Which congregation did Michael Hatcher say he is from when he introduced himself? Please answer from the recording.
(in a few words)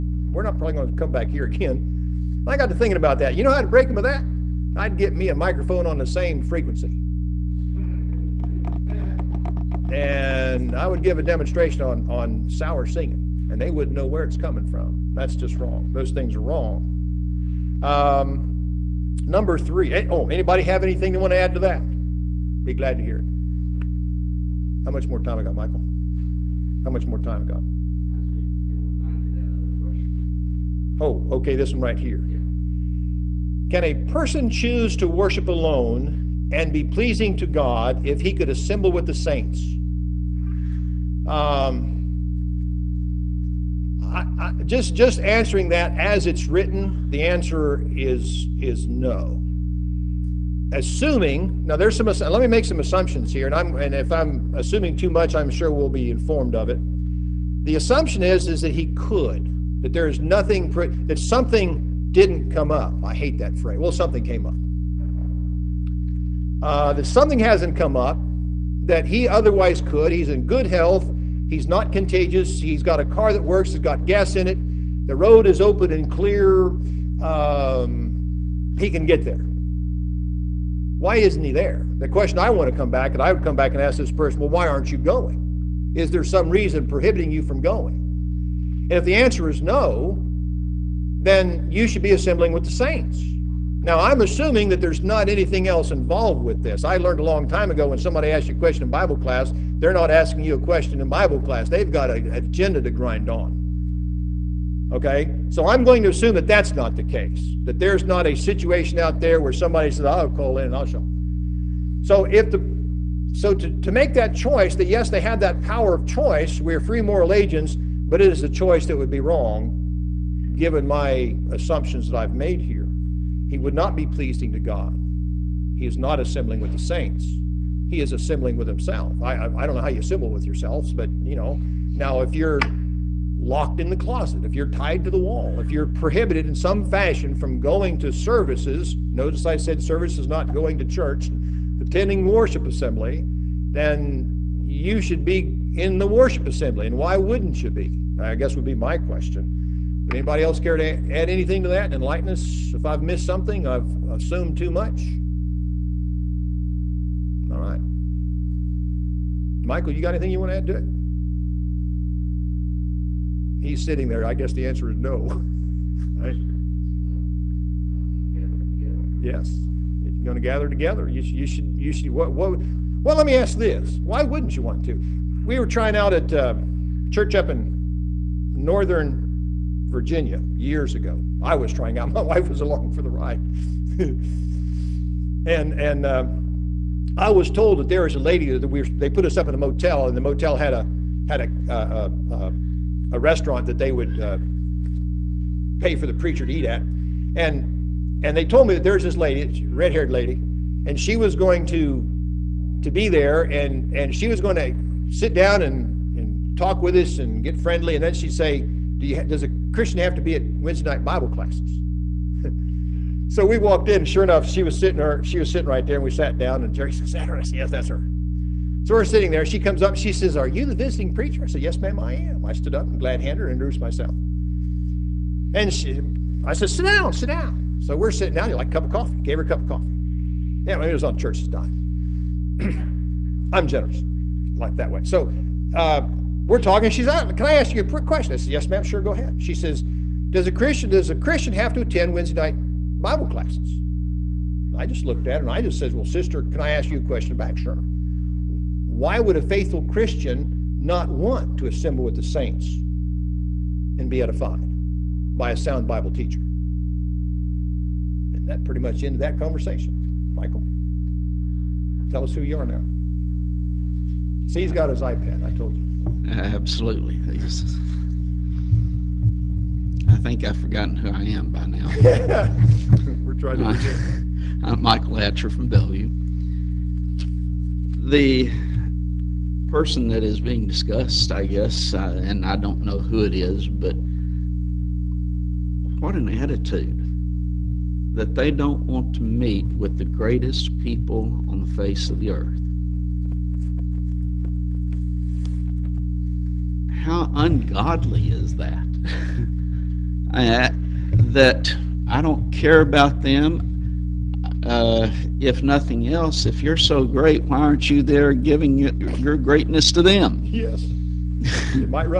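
Bellview.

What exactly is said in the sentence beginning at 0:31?
Oh, okay, this one right here.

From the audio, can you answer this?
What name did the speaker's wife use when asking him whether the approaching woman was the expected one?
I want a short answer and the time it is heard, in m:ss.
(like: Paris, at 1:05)
Jerry, at 3:36.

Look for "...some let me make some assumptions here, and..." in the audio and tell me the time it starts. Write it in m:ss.
0:51.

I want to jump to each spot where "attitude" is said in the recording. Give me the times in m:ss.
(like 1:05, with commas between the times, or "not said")
4:46.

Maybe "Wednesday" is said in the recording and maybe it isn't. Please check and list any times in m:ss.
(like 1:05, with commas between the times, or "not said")
3:30, 4:02.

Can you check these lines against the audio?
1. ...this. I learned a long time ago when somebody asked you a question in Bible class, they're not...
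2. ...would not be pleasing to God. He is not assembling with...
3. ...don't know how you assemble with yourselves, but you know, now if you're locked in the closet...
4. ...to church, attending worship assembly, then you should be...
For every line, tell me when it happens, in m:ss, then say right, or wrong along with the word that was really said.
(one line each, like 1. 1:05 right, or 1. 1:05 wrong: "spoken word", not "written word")
1. 1:36 right
2. 2:03 right
3. 2:09 right
4. 2:20 right.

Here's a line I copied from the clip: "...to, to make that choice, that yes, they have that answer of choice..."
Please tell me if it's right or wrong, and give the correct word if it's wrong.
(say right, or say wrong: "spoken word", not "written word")
wrong: "power", not "answer".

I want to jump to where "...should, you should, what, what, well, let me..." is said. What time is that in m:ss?
2:51.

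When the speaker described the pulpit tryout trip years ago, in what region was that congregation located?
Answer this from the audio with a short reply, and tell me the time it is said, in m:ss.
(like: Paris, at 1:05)
northern Virginia, at 2:58.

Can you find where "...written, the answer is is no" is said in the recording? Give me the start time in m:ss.
0:46.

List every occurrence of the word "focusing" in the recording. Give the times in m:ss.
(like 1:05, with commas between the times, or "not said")
not said.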